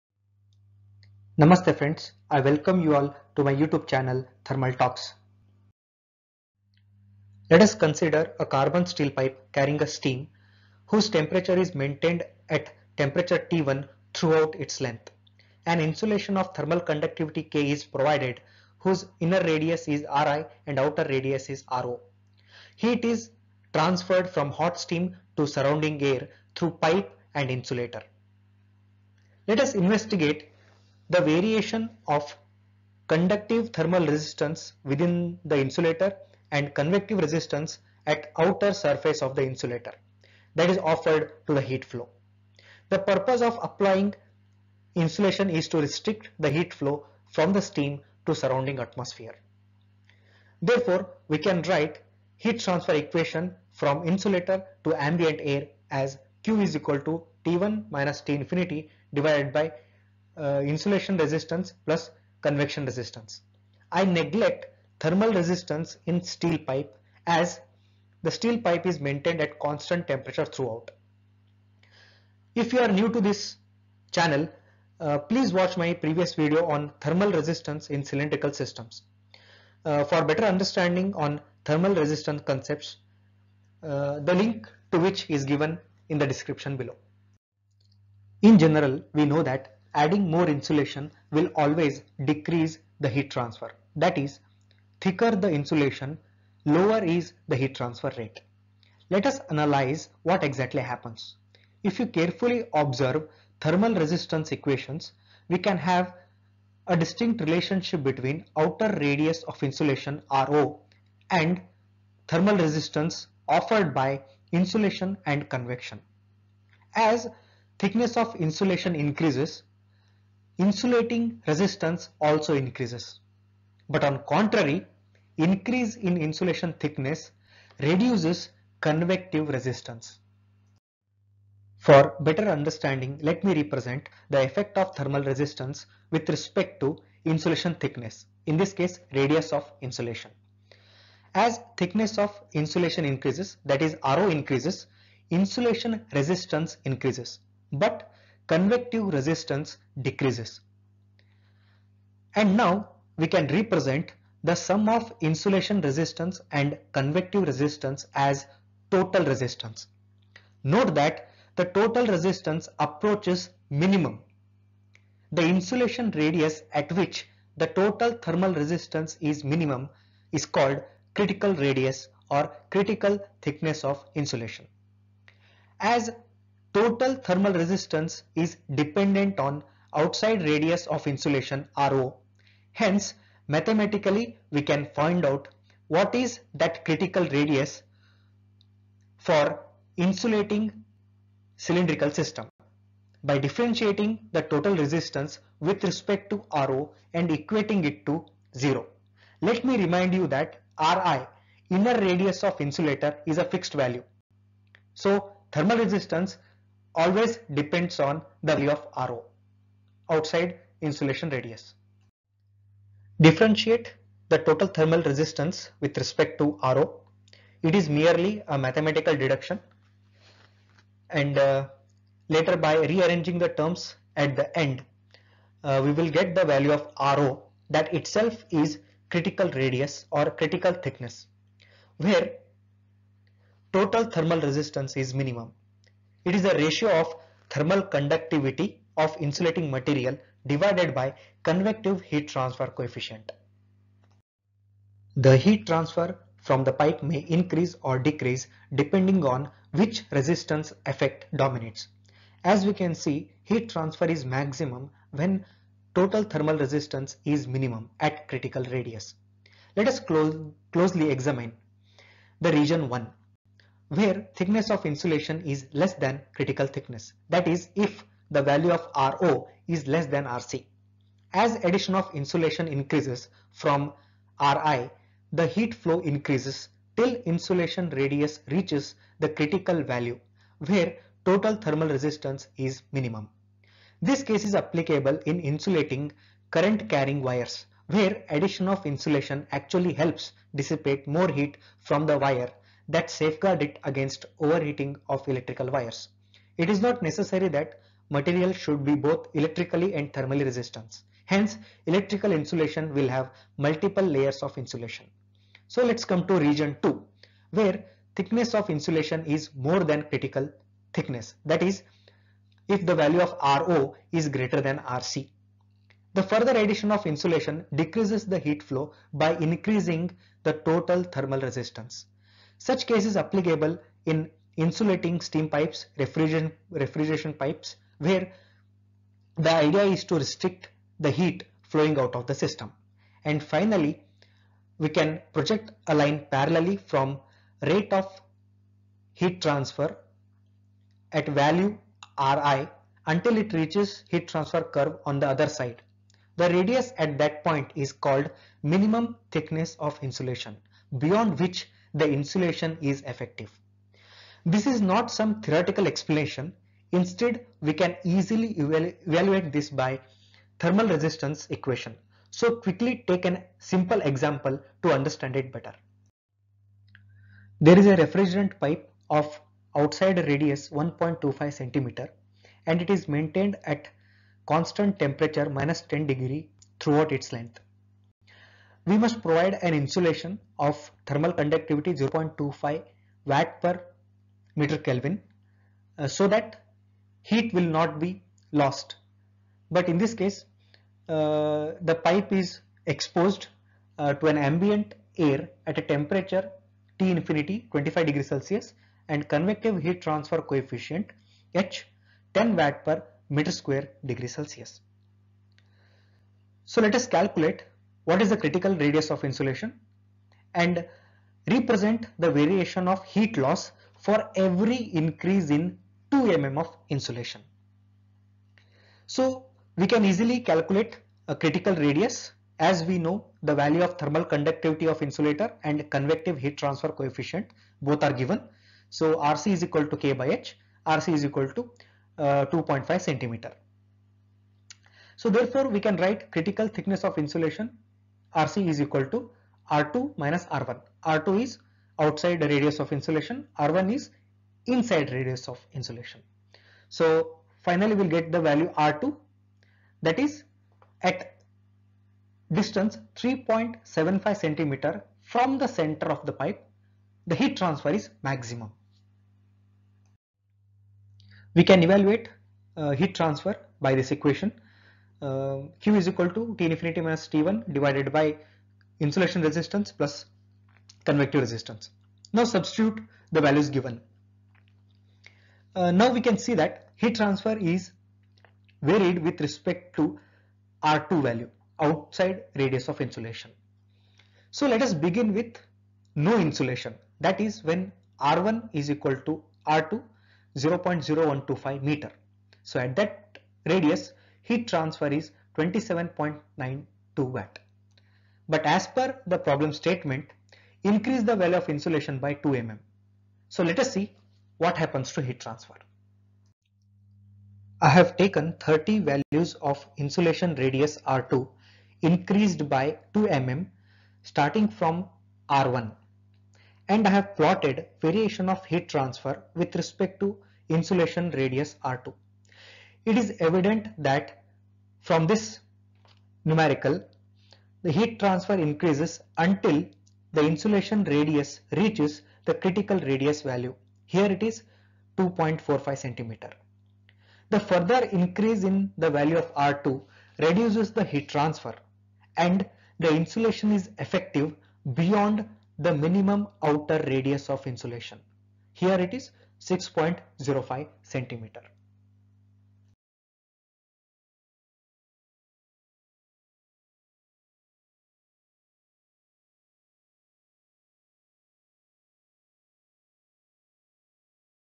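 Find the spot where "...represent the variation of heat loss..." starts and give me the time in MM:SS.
06:51.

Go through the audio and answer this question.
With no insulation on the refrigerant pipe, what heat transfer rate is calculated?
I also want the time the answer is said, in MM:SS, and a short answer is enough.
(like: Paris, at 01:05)
27.92 watts, at 08:15.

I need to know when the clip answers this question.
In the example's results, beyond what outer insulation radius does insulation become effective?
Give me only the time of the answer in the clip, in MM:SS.
09:09.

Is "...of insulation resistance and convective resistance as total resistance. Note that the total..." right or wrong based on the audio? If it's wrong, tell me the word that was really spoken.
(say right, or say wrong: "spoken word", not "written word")
right.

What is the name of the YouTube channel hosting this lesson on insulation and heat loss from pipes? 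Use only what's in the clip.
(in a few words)
Thermal Talks.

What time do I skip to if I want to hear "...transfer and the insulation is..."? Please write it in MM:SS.
09:01.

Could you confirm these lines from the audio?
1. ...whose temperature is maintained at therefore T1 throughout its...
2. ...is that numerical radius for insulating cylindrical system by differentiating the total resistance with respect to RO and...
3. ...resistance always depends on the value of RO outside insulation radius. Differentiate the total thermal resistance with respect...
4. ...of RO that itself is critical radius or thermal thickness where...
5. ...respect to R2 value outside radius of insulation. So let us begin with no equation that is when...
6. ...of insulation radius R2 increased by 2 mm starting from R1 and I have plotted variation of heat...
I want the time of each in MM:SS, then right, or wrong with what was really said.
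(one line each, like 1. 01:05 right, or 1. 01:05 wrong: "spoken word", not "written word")
1. 00:10 wrong: "temperature", not "therefore"
2. 03:06 wrong: "critical", not "numerical"
3. 03:25 right
4. 03:46 wrong: "critical", not "thermal"
5. 07:59 wrong: "insulation", not "equation"
6. 08:29 right.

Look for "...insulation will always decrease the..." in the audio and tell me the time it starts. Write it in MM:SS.
01:30.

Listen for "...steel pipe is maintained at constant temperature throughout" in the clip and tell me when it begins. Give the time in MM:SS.
01:08.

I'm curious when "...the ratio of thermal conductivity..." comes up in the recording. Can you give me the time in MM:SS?
03:56.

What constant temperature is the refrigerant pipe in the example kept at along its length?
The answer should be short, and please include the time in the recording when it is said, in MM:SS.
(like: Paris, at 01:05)
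minus 10 degrees, at 06:15.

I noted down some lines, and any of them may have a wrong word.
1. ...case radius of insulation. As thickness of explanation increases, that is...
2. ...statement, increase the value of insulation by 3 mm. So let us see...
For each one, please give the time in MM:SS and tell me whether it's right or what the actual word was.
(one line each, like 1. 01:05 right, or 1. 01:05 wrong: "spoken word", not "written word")
1. 02:18 wrong: "insulation", not "explanation"
2. 08:19 wrong: "2", not "3".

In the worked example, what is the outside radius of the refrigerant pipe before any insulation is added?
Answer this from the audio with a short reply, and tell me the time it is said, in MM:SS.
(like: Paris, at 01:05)
1.25 centimeter, at 06:10.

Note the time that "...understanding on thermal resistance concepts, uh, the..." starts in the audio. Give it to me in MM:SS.
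01:20.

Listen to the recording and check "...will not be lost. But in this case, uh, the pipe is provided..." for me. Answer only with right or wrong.
wrong.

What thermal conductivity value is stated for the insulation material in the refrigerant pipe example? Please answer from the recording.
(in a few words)
0.25 W/mK.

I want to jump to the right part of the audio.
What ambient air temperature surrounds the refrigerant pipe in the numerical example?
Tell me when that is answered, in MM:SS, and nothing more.
06:37.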